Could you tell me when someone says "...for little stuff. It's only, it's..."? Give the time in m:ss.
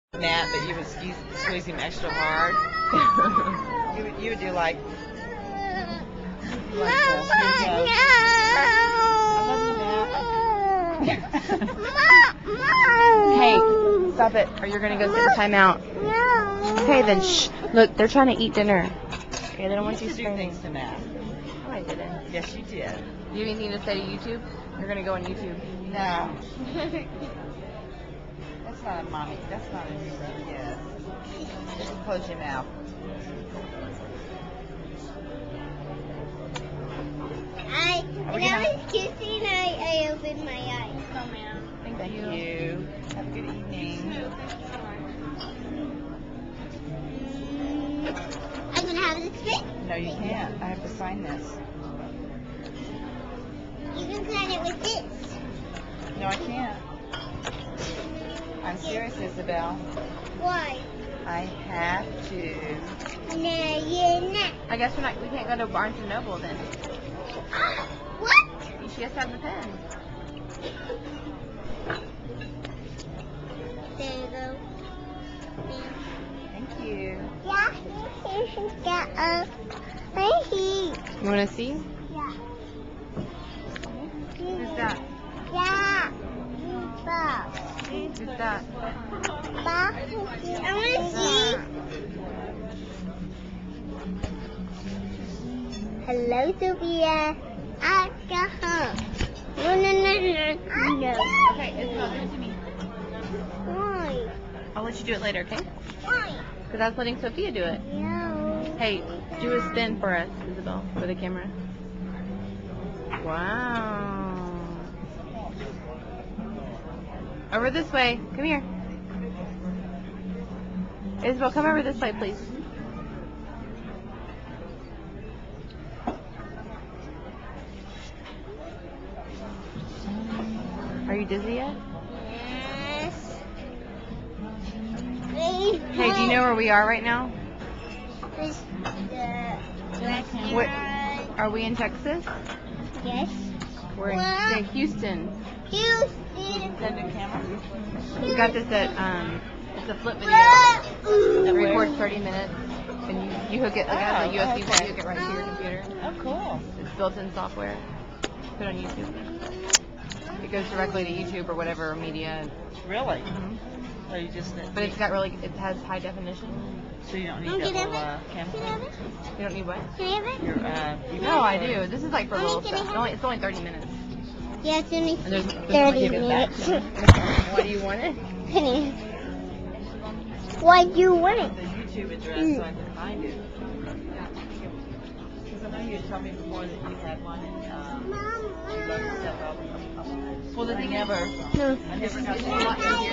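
2:52.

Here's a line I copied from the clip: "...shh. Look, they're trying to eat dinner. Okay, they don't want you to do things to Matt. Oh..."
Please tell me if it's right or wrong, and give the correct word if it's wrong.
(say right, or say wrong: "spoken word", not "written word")
right.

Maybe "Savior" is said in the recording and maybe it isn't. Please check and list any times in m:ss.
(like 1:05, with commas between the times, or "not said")
not said.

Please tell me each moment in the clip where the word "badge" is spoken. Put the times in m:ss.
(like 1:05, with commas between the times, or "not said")
not said.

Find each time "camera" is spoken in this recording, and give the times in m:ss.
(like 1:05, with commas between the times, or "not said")
1:51, 2:48.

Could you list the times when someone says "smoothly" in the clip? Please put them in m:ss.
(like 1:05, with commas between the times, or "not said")
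not said.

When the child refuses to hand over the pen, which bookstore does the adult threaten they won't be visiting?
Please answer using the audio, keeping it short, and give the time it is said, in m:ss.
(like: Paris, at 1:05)
Barnes and Noble, at 1:05.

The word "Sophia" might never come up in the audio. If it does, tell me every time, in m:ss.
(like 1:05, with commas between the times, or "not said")
1:36, 1:47.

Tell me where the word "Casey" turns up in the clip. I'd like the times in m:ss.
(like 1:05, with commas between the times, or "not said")
not said.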